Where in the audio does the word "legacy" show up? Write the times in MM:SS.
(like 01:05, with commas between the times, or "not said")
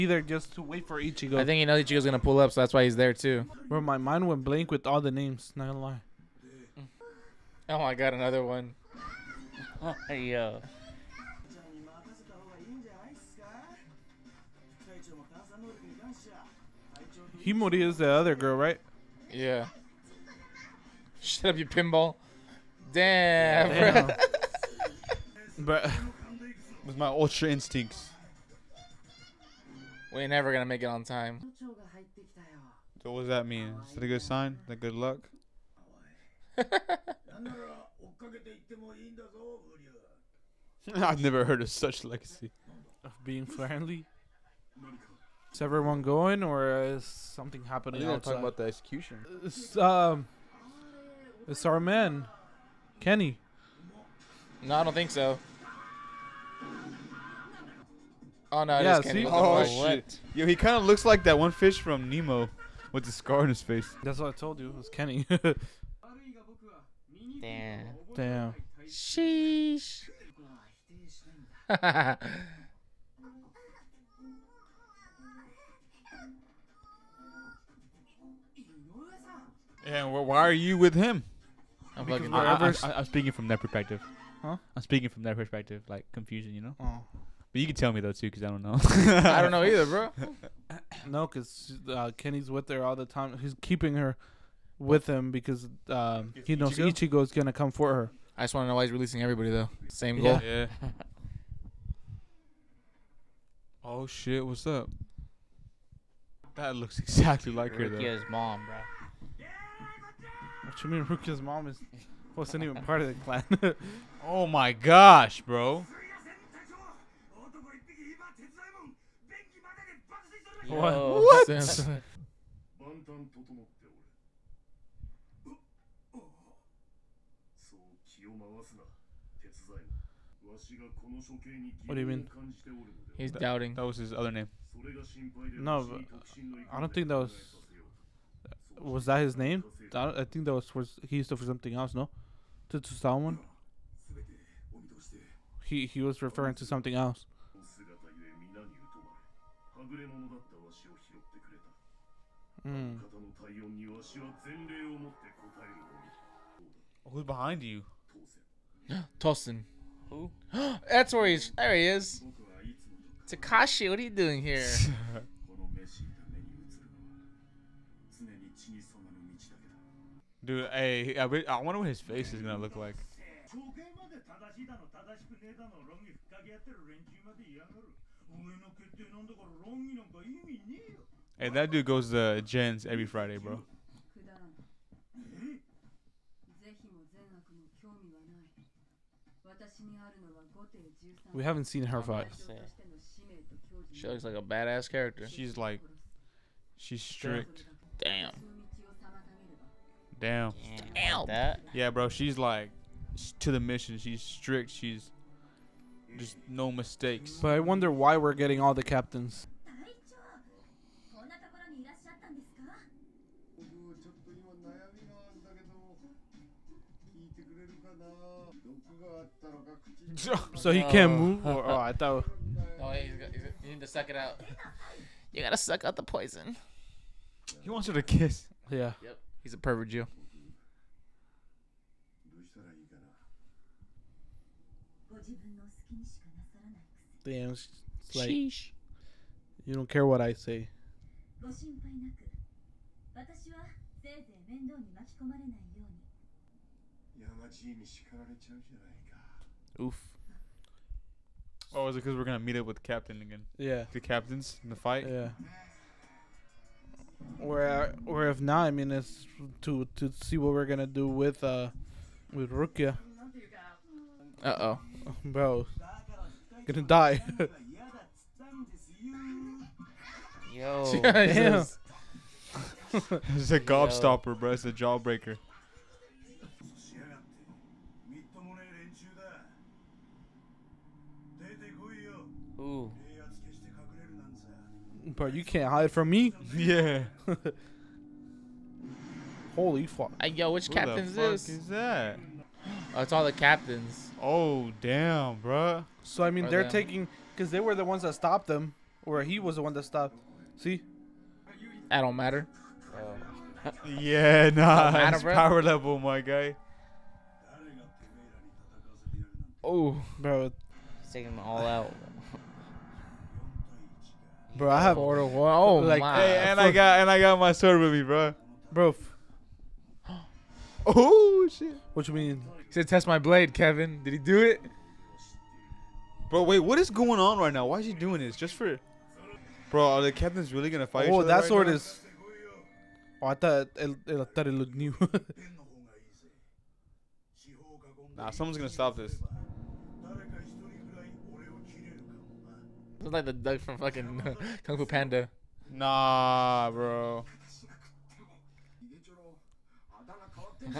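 00:42.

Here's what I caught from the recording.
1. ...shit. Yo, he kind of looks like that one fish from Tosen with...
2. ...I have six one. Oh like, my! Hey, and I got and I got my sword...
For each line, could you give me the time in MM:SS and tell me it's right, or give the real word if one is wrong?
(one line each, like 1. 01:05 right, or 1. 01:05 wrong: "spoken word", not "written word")
1. 00:59 wrong: "Nemo", not "Tosen"
2. 05:14 wrong: "four", not "six".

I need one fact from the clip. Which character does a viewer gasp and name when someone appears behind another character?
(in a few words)
Tosen.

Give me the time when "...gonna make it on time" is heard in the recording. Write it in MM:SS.
00:30.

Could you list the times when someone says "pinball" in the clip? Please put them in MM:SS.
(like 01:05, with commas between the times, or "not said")
00:21.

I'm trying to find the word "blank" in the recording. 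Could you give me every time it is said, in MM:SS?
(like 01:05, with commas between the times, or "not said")
00:04.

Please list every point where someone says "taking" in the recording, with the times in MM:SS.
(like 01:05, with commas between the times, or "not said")
04:56, 05:11.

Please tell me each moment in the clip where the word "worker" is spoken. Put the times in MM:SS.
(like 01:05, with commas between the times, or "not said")
not said.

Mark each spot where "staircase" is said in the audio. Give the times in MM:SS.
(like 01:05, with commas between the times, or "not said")
not said.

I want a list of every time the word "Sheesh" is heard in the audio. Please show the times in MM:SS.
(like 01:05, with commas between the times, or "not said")
01:08, 03:58.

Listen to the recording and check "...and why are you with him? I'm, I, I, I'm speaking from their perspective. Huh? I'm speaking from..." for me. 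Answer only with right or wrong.
right.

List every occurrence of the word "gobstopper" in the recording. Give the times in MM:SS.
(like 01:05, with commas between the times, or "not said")
04:33.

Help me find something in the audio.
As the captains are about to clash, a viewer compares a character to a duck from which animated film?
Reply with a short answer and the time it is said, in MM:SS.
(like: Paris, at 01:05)
Kung Fu Panda, at 05:44.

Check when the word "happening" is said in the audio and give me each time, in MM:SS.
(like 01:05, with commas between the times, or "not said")
00:47.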